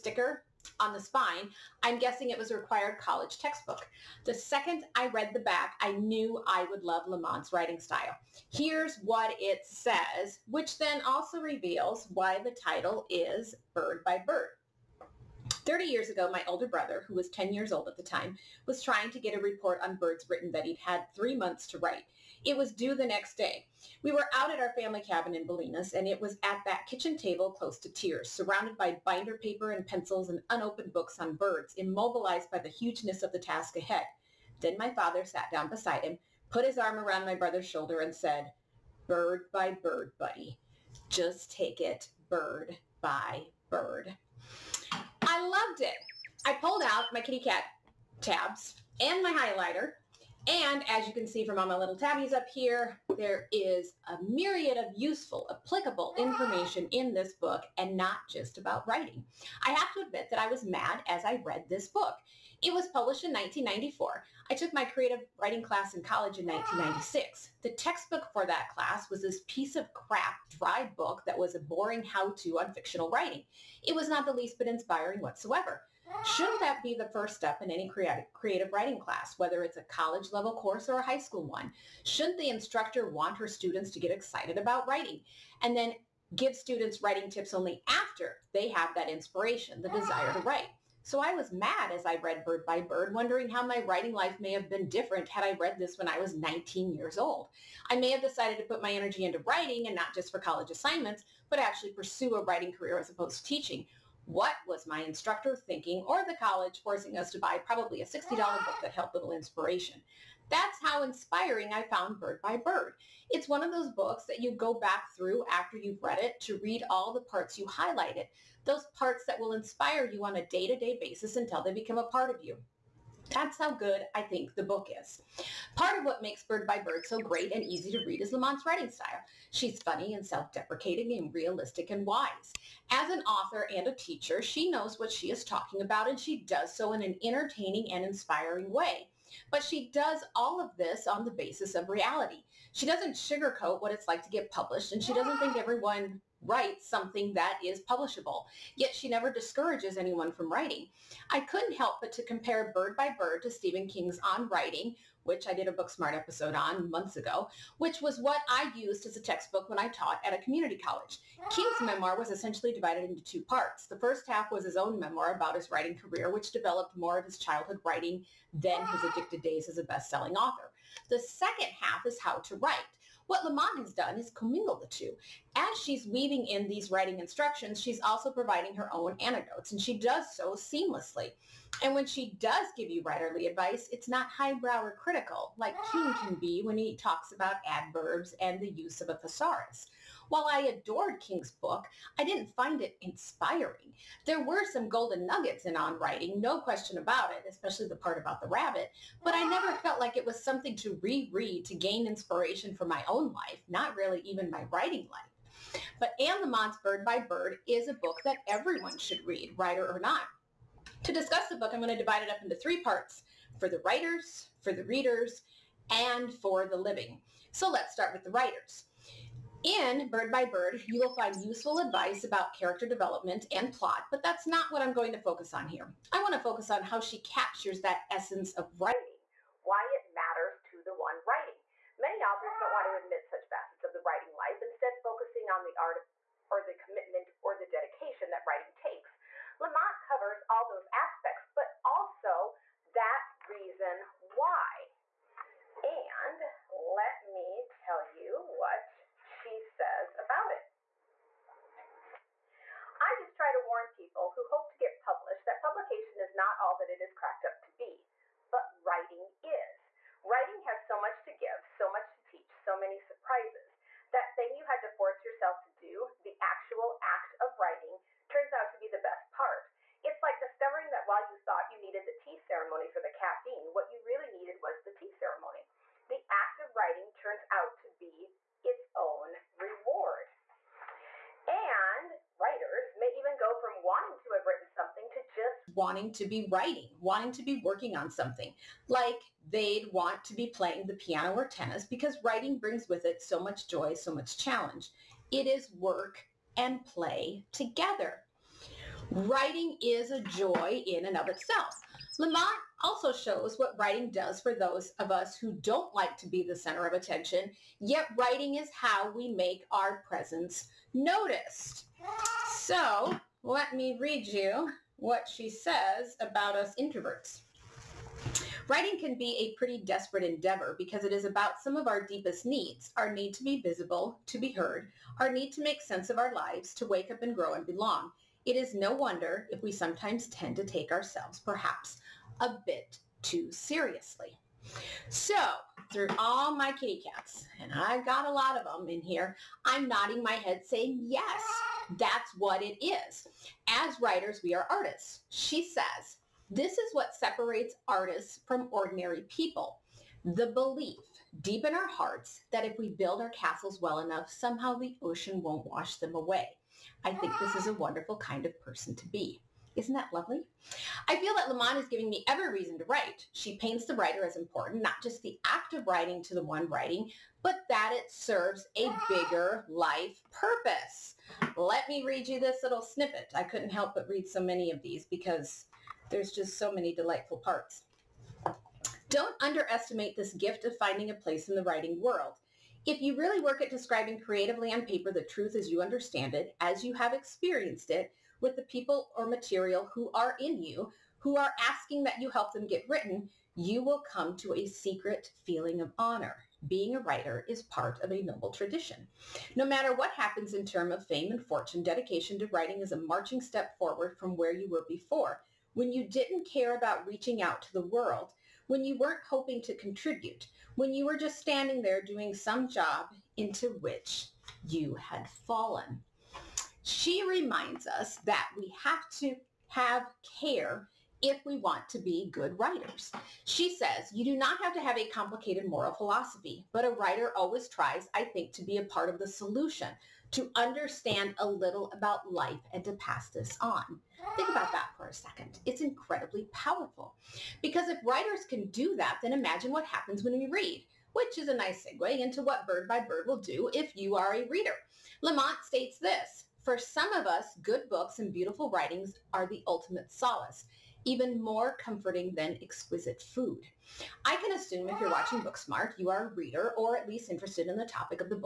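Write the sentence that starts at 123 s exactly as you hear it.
That's how good I think the book is.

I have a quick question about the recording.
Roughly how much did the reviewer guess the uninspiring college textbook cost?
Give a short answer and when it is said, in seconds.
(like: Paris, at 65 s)
$60, at 108 s.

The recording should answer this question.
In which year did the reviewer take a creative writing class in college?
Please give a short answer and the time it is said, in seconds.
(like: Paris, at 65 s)
1996, at 66 s.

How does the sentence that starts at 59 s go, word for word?
I have to admit that I was mad as I read this book.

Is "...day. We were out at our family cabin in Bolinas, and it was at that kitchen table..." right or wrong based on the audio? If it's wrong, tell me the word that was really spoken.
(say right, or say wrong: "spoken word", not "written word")
right.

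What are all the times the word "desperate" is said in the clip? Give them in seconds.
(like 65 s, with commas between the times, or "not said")
319 s.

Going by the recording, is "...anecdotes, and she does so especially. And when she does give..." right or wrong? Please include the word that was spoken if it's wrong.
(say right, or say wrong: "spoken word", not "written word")
wrong: "seamlessly", not "especially".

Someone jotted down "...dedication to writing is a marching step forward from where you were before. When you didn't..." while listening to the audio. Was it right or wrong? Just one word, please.
right.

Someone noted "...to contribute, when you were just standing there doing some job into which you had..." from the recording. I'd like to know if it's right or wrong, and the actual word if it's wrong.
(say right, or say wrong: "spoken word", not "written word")
right.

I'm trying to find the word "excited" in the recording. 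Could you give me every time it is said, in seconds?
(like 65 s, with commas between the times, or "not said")
84 s.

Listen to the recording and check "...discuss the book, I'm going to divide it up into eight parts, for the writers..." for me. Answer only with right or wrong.
wrong.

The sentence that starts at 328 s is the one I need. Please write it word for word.
It is no wonder if we sometimes tend to take ourselves perhaps a bit too seriously.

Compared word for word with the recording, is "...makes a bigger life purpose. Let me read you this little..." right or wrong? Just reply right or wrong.
wrong.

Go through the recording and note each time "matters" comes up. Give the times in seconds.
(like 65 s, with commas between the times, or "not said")
230 s, 399 s.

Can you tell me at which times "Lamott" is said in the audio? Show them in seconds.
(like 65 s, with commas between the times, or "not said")
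7 s, 128 s, 173 s, 206 s, 239 s, 302 s, 361 s, 445 s.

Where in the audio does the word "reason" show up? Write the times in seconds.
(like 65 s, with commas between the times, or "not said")
243 s, 362 s.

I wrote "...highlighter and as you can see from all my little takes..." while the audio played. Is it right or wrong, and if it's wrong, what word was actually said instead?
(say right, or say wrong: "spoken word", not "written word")
wrong: "tabbies", not "takes".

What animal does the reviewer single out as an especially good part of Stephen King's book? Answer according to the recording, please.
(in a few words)
rabbit.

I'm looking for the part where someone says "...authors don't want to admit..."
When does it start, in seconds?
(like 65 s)
232 s.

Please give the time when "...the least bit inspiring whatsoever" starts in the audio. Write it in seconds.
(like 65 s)
74 s.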